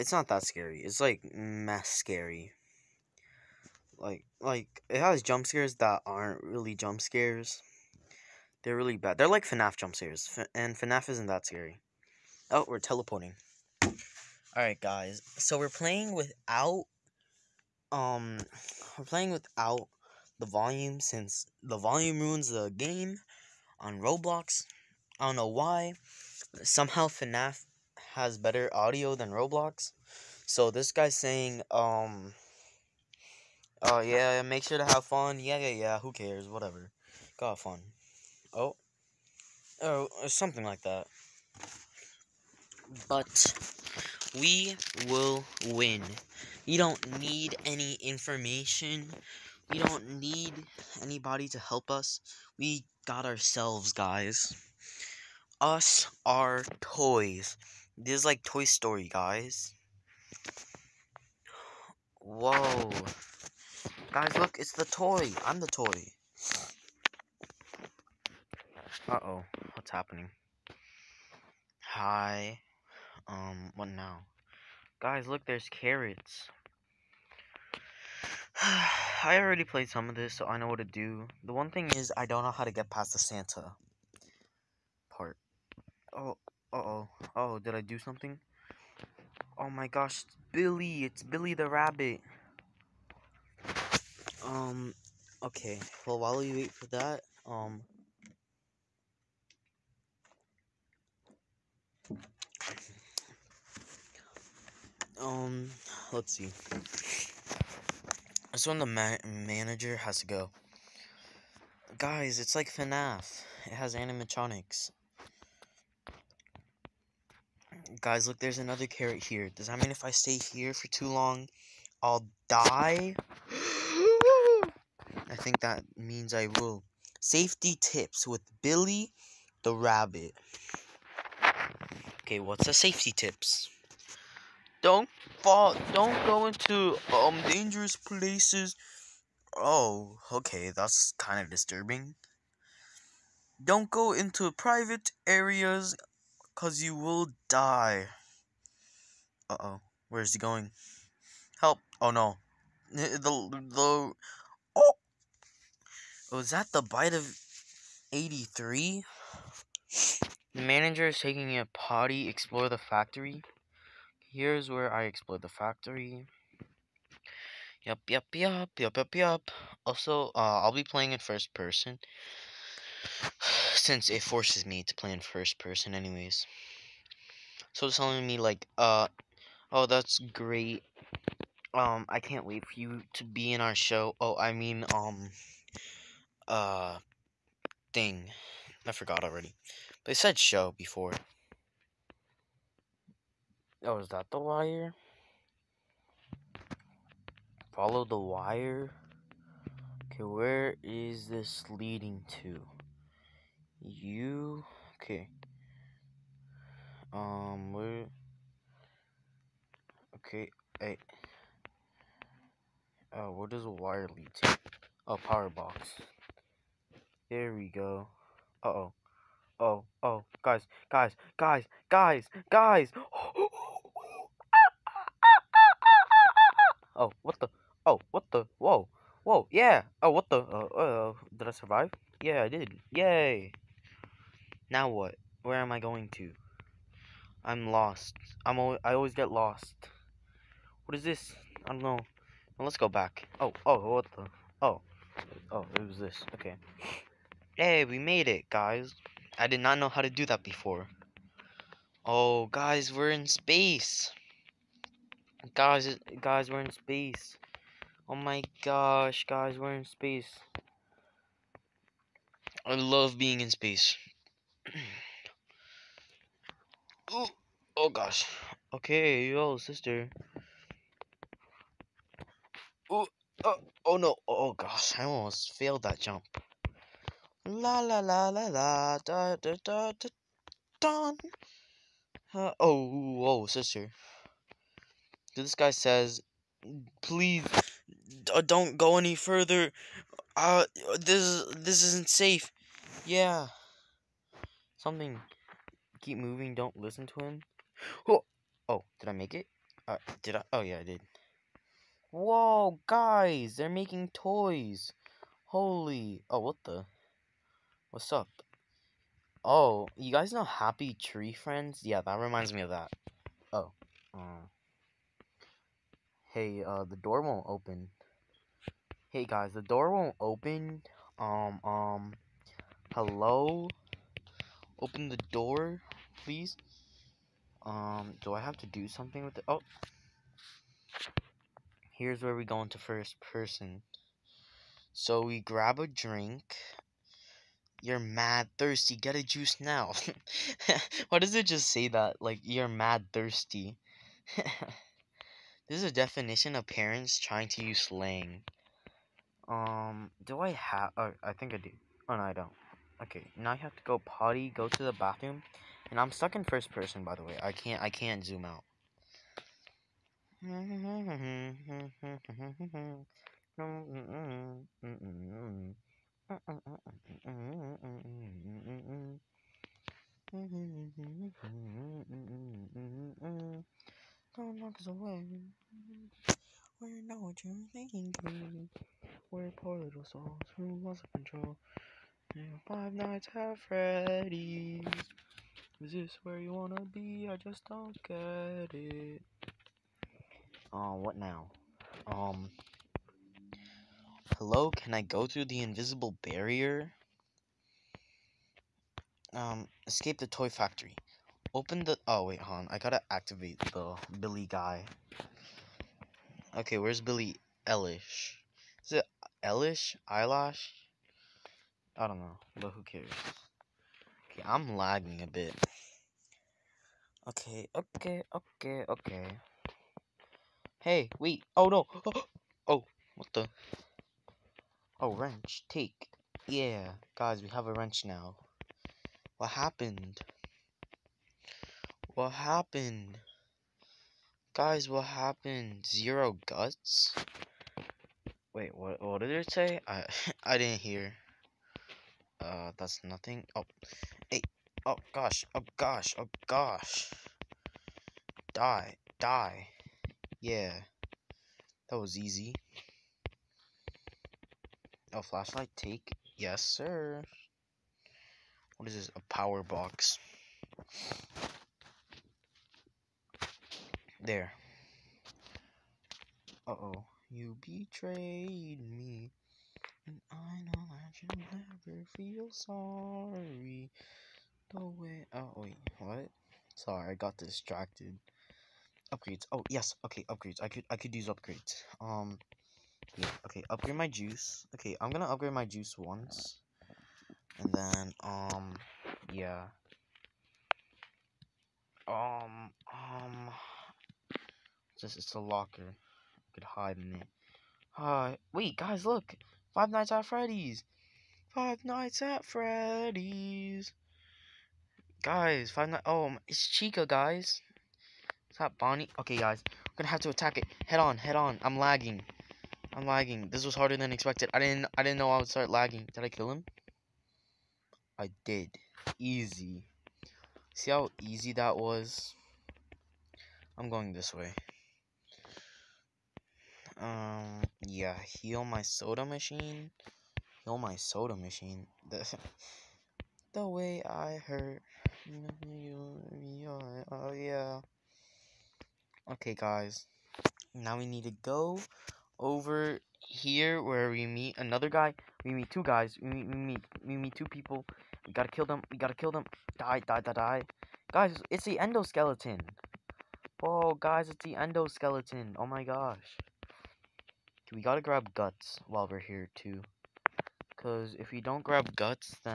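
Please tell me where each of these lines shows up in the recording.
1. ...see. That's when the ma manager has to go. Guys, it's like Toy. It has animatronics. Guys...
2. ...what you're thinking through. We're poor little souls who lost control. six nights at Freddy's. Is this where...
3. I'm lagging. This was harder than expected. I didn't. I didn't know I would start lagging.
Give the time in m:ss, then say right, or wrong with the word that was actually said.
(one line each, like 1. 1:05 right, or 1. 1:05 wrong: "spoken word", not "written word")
1. 1:46 wrong: "FNAF", not "Toy"
2. 6:17 wrong: "five", not "six"
3. 8:32 right.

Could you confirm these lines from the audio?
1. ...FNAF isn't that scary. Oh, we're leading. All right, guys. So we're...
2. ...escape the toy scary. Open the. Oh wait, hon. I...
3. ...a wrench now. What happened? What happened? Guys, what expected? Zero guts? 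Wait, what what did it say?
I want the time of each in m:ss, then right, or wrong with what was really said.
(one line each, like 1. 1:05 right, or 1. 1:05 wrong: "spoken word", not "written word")
1. 0:10 wrong: "teleporting", not "leading"
2. 6:39 wrong: "factory", not "scary"
3. 7:07 wrong: "happened", not "expected".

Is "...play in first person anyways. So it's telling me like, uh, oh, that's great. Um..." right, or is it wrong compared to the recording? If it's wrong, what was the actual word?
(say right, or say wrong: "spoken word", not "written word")
right.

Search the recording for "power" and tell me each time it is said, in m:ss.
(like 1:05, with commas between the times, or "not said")
3:35, 7:39.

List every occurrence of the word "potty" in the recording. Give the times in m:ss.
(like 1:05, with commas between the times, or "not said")
2:41, 5:53.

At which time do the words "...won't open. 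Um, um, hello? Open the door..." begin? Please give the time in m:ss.
5:19.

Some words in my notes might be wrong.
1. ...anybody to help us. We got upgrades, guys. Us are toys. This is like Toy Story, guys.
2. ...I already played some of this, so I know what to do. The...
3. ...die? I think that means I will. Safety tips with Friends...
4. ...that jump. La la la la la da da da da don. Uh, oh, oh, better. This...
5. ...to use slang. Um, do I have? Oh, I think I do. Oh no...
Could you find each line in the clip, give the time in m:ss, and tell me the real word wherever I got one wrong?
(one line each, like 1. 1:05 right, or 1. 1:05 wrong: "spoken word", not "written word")
1. 0:51 wrong: "ourselves", not "upgrades"
2. 1:18 right
3. 2:02 wrong: "Billy", not "Friends"
4. 4:35 wrong: "sister", not "better"
5. 5:47 right.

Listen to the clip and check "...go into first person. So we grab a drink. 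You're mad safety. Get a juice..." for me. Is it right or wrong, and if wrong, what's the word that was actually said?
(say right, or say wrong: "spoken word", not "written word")
wrong: "thirsty", not "safety".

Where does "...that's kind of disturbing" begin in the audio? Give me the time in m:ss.
2:20.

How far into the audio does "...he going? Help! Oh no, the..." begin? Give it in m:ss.
2:30.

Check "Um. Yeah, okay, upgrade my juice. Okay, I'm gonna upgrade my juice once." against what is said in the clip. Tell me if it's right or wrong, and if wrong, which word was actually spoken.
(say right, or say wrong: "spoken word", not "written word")
right.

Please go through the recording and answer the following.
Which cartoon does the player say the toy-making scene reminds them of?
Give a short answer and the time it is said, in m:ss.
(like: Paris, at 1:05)
Happy Tree Friends, at 5:10.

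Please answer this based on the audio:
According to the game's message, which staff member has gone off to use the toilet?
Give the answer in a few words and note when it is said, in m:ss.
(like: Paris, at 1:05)
The Manager, at 2:40.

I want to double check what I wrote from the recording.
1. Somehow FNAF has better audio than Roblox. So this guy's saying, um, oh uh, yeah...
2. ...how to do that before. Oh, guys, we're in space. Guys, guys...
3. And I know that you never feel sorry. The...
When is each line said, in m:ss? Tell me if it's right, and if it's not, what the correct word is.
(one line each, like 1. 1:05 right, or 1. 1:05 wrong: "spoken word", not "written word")
1. 0:26 right
2. 4:09 right
3. 7:50 right.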